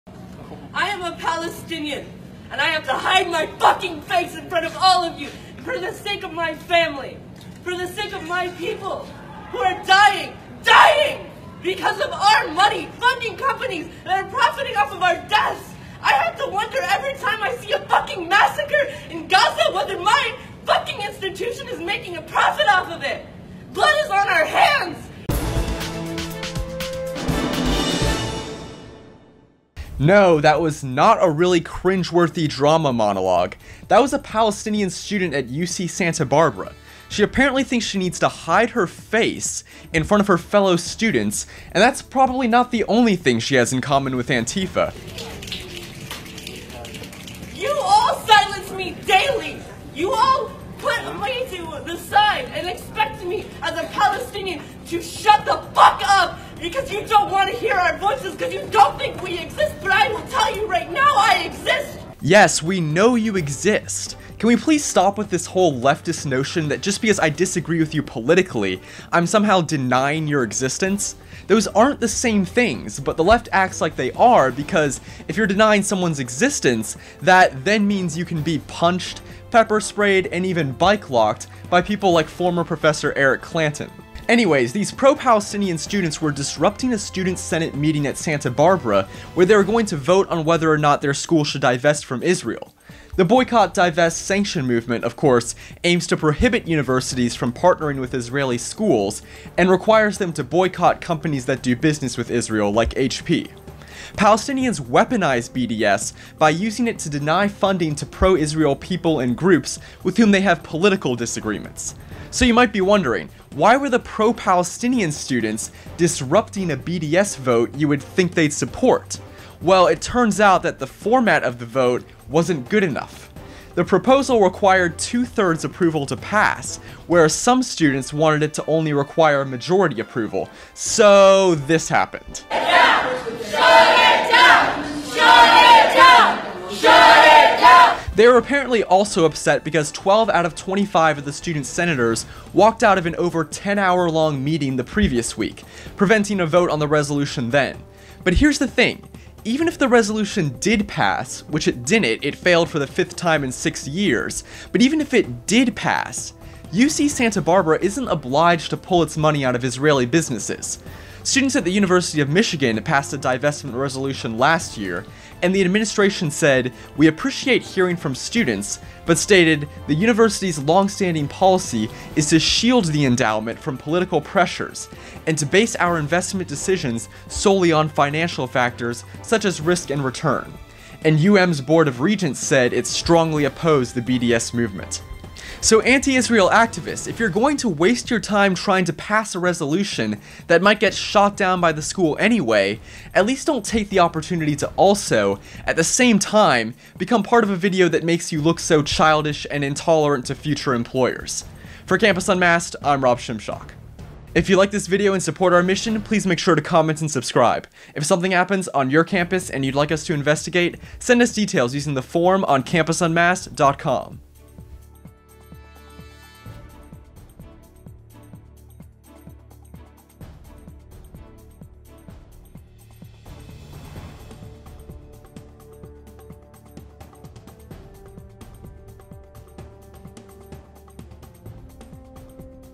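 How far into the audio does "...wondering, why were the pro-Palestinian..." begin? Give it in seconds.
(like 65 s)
112 s.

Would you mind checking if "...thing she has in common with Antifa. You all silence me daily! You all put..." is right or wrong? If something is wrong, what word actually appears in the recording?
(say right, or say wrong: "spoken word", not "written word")
right.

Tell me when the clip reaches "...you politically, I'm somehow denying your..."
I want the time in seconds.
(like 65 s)
67 s.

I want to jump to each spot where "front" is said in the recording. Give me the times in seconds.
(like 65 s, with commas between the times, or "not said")
4 s, 40 s.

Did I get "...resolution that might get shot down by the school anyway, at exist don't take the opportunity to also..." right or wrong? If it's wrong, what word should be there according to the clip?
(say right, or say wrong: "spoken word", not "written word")
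wrong: "least", not "exist".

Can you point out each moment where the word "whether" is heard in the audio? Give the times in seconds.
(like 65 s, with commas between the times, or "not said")
19 s, 90 s.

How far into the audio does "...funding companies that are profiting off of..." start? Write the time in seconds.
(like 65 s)
12 s.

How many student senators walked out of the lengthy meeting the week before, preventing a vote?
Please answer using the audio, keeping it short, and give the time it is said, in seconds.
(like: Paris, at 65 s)
12, at 139 s.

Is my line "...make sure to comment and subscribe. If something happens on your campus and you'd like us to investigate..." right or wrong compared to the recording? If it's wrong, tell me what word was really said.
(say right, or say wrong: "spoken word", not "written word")
right.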